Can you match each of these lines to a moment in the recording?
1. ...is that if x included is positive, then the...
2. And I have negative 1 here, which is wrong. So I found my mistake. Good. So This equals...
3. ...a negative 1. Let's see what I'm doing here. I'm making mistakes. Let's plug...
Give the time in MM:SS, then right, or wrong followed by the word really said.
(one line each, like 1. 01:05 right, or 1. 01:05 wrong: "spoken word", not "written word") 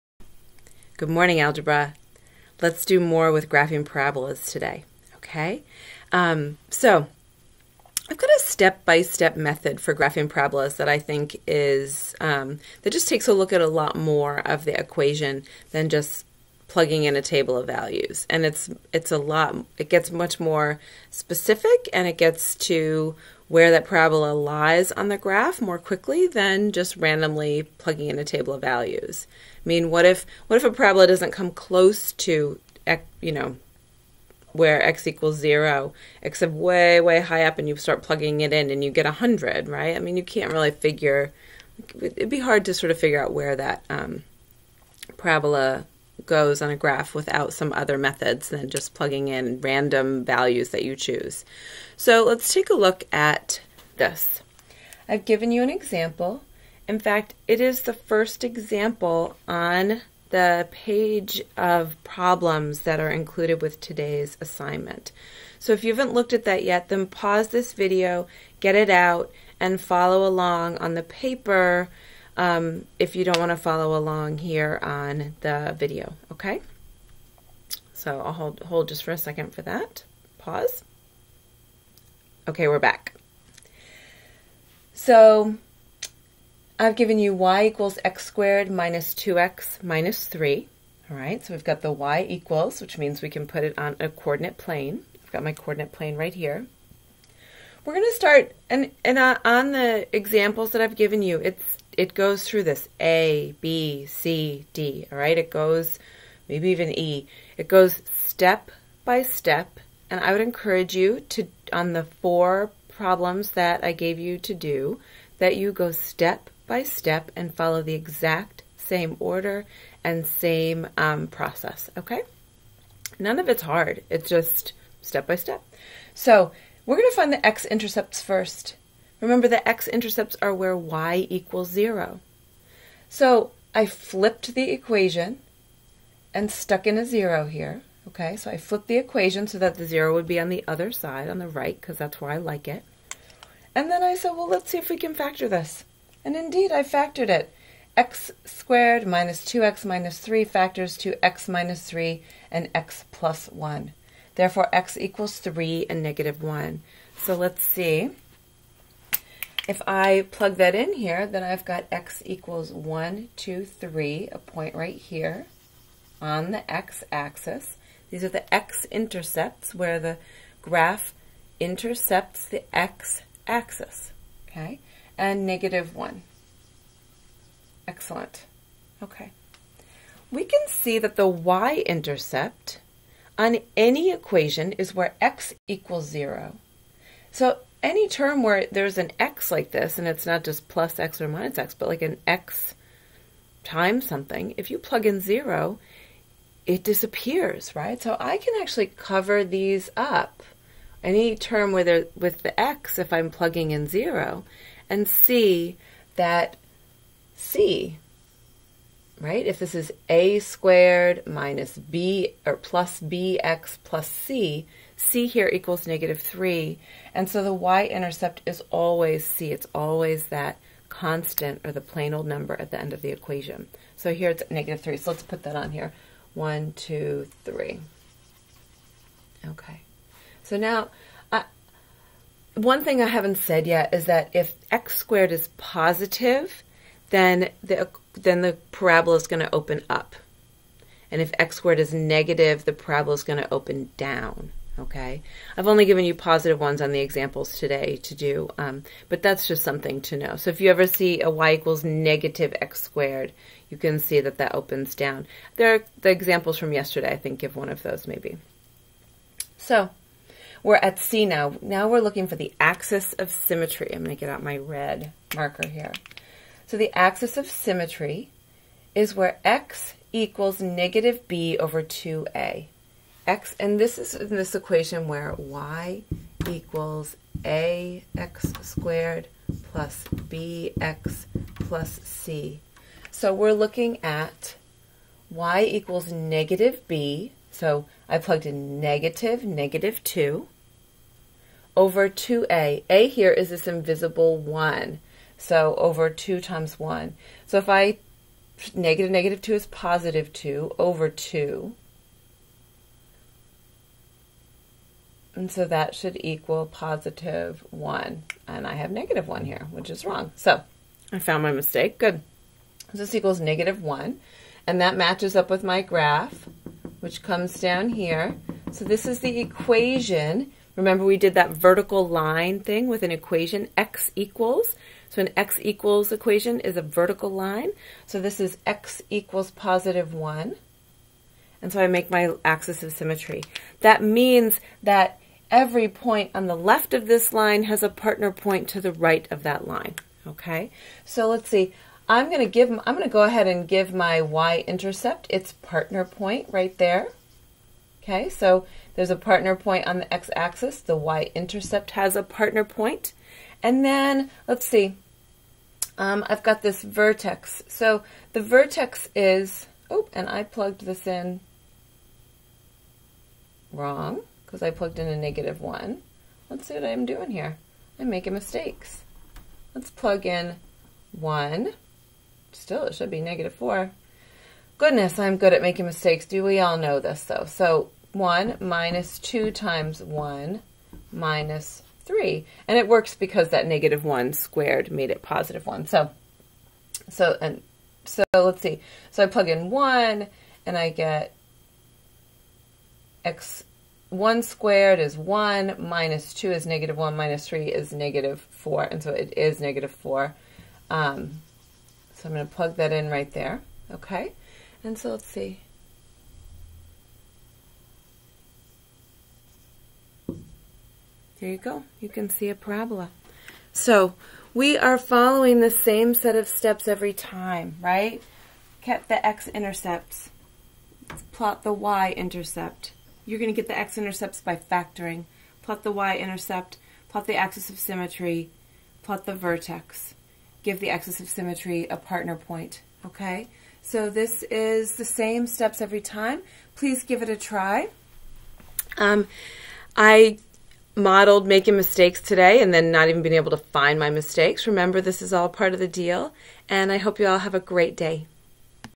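1. 03:53 wrong: "squared", not "included"
2. 05:08 right
3. 06:05 right.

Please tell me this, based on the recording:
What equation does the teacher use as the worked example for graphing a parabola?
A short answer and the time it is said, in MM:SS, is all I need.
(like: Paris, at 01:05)
y = x^2 - 2x - 3, at 01:27.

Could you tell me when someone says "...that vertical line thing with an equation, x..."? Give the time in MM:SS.
05:21.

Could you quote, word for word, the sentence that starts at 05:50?
The y-intercept has a partner And then, let's see, um, I've got this vertex.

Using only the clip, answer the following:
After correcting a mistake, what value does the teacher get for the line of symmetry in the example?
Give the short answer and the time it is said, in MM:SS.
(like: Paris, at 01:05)
x = 1, at 05:28.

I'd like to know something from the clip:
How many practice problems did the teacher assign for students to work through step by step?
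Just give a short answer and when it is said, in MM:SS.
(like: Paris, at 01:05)
4, at 01:52.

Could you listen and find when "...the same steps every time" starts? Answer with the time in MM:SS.
07:14.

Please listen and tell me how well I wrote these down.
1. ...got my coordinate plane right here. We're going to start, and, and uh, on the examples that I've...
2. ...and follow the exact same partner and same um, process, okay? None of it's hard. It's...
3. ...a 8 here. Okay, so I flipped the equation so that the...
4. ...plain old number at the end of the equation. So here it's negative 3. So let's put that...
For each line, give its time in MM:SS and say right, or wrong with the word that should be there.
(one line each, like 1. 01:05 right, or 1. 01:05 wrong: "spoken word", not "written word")
1. 01:35 right
2. 01:57 wrong: "order", not "partner"
3. 02:16 wrong: "0", not "8"
4. 03:41 right.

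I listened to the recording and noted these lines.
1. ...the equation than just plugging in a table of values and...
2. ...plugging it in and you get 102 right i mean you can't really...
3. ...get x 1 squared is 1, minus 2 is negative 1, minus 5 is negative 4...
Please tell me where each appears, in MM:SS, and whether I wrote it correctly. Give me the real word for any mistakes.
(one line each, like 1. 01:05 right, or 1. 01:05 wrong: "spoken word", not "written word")
1. 00:14 right
2. 00:38 wrong: "100", not "102"
3. 06:30 wrong: "3", not "5".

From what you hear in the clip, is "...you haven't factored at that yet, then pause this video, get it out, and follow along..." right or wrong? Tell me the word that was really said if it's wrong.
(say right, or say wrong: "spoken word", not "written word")
wrong: "looked", not "factored".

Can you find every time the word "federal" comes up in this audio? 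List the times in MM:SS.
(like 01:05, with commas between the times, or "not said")
not said.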